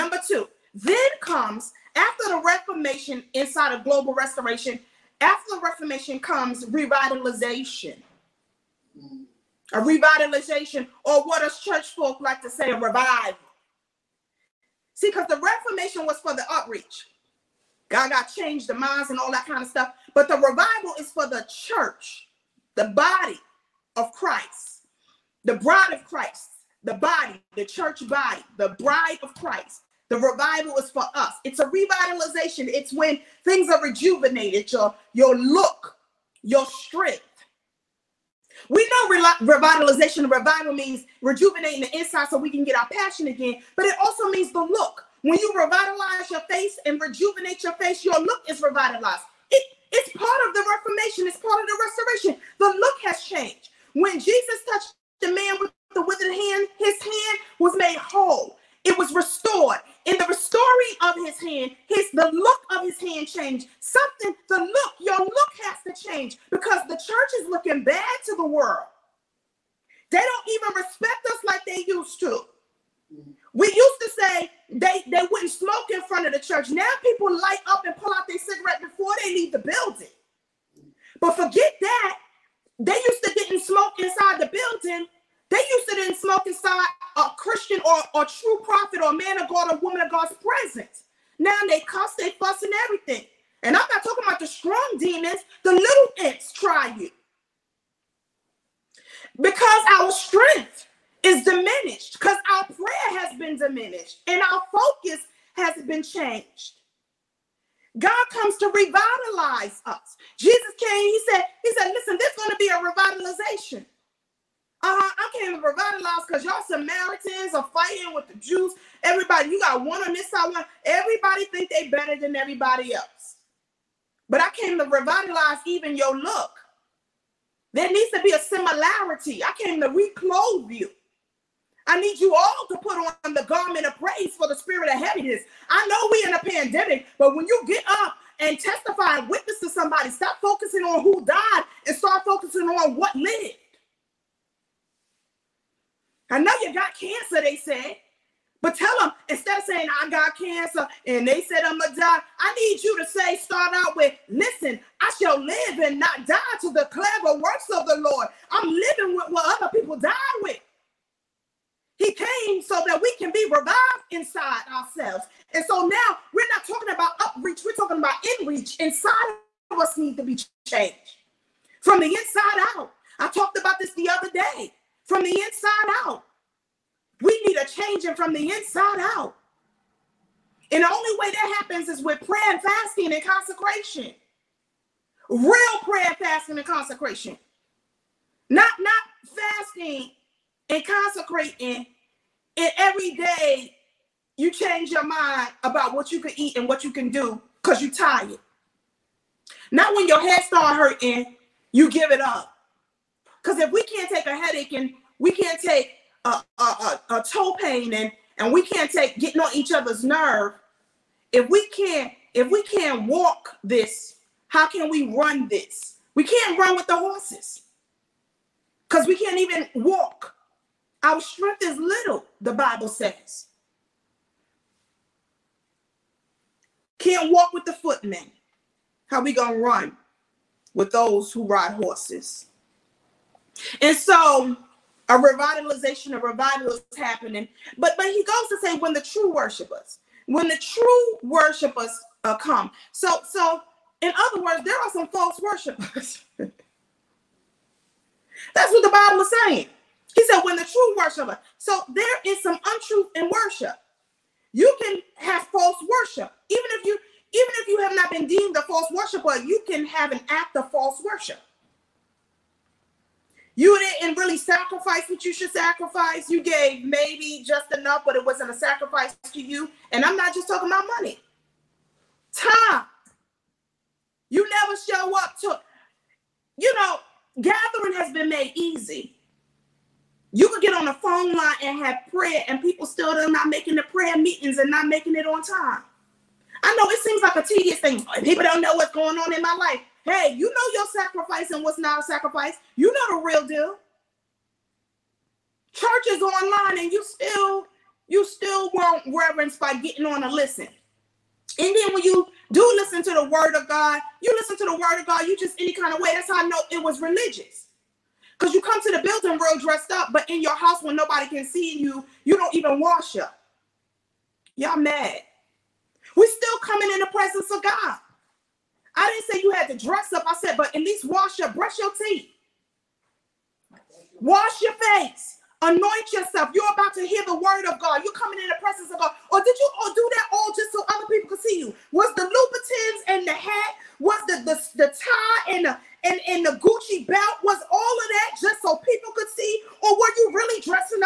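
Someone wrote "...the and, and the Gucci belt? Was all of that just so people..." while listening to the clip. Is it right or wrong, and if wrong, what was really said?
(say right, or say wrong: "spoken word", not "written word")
right.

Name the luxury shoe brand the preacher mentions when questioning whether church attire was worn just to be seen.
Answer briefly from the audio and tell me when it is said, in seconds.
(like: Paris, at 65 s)
Louboutins, at 332 s.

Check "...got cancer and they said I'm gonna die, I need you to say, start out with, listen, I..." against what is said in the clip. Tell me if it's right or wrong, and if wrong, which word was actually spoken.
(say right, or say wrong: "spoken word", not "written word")
right.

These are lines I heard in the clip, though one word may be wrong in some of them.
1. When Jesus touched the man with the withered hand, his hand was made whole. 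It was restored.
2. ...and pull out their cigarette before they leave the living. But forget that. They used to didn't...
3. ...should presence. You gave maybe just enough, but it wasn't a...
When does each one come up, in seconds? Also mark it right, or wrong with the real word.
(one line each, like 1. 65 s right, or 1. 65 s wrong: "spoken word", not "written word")
1. 53 s right
2. 77 s wrong: "building", not "living"
3. 265 s wrong: "sacrifice", not "presence".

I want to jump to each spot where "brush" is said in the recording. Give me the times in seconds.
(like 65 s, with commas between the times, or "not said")
321 s.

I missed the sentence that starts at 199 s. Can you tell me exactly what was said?
Not when your head start hurting, you give it up.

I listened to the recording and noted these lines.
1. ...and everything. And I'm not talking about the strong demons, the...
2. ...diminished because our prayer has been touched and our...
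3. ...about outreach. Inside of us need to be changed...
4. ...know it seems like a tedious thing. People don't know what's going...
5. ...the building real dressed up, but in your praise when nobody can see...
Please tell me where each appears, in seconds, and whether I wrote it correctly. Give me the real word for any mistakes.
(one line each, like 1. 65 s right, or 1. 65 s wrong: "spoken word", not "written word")
1. 92 s right
2. 101 s wrong: "diminished", not "touched"
3. 167 s wrong: "inreach", not "outreach"
4. 286 s right
5. 308 s wrong: "house", not "praise".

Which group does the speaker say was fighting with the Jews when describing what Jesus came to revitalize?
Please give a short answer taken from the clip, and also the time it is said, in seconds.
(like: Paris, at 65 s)
Samaritans, at 116 s.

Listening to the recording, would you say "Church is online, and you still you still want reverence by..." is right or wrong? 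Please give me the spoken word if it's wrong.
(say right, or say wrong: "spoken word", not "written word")
right.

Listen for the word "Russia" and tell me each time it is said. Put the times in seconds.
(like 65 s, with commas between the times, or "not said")
not said.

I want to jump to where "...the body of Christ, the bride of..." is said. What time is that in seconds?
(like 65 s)
22 s.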